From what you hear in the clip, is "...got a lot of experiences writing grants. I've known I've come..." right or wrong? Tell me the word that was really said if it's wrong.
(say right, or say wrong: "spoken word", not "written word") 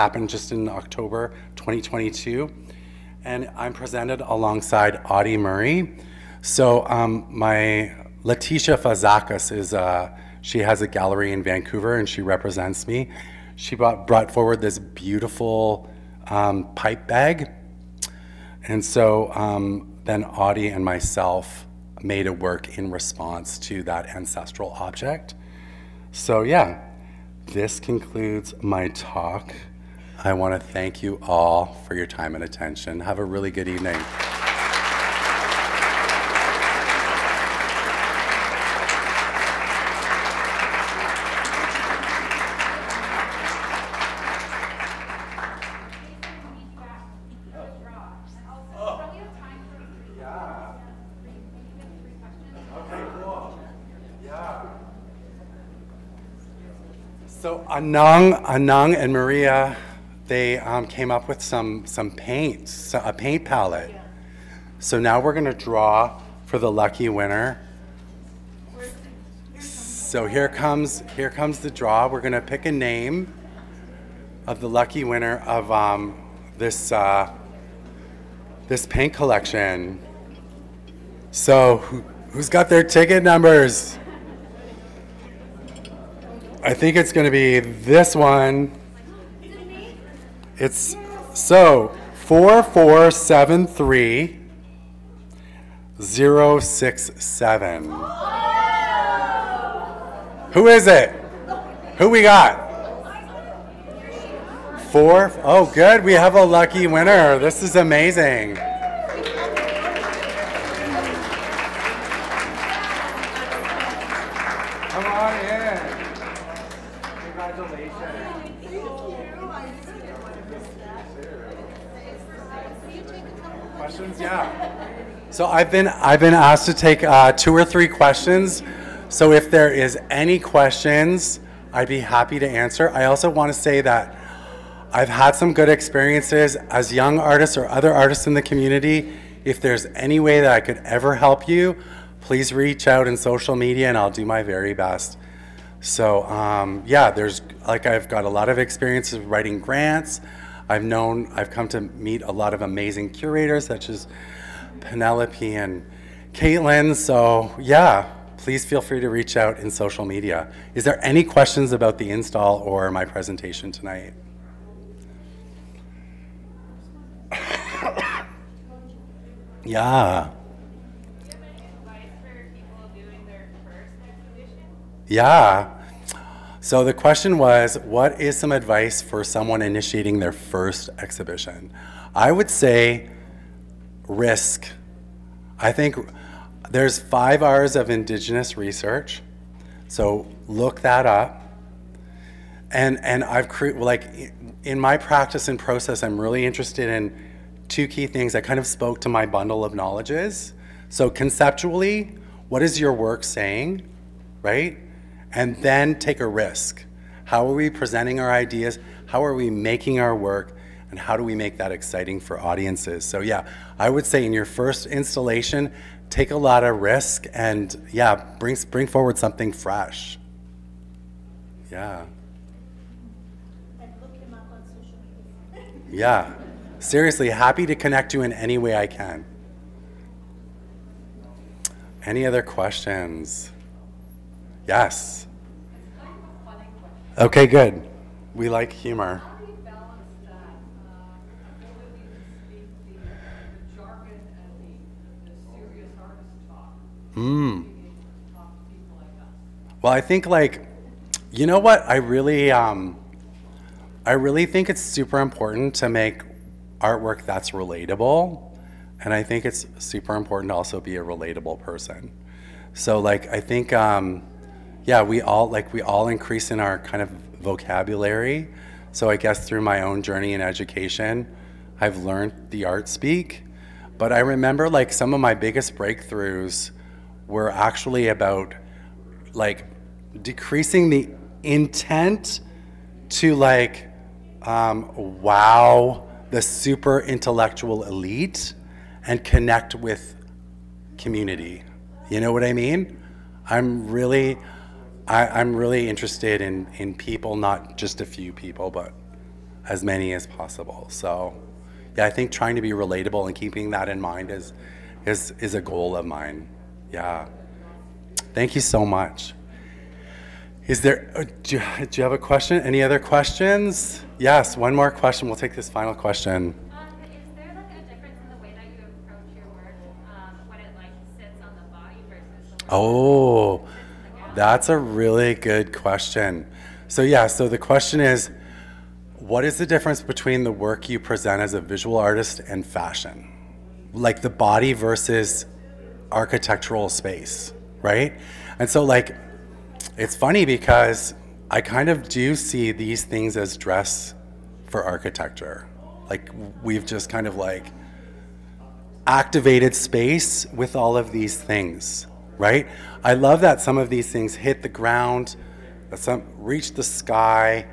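right.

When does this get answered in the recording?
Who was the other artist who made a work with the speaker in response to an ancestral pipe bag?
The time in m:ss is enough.
0:05.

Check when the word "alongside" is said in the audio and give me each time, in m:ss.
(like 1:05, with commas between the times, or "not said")
0:04.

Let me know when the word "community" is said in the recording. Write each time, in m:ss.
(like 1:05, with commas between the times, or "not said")
2:18, 4:50.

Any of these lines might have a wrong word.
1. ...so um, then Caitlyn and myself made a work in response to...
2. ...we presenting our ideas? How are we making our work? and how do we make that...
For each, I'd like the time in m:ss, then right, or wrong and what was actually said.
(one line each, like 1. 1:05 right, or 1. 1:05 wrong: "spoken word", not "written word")
1. 0:18 wrong: "Audie", not "Caitlyn"
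2. 3:27 right.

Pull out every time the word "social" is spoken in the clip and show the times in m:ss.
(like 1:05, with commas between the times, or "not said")
2:23, 2:39.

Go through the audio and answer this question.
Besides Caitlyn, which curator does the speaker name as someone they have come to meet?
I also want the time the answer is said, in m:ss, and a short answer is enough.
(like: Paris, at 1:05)
Penelope, at 2:34.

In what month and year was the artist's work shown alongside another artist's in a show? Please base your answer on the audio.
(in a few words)
October 2022.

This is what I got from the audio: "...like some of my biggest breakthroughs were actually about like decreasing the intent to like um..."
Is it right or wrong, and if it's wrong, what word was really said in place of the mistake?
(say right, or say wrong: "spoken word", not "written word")
right.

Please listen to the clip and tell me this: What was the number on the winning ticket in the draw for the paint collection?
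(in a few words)
4473 067.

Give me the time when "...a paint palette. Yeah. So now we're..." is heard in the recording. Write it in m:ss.
1:02.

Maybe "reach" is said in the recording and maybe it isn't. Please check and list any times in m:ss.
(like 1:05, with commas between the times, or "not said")
2:22, 2:39, 5:56.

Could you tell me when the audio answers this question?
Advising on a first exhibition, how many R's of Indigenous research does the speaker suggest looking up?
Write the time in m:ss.
3:06.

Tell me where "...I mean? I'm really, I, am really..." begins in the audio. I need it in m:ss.
4:52.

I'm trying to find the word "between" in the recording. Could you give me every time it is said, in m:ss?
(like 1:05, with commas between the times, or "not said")
5:30.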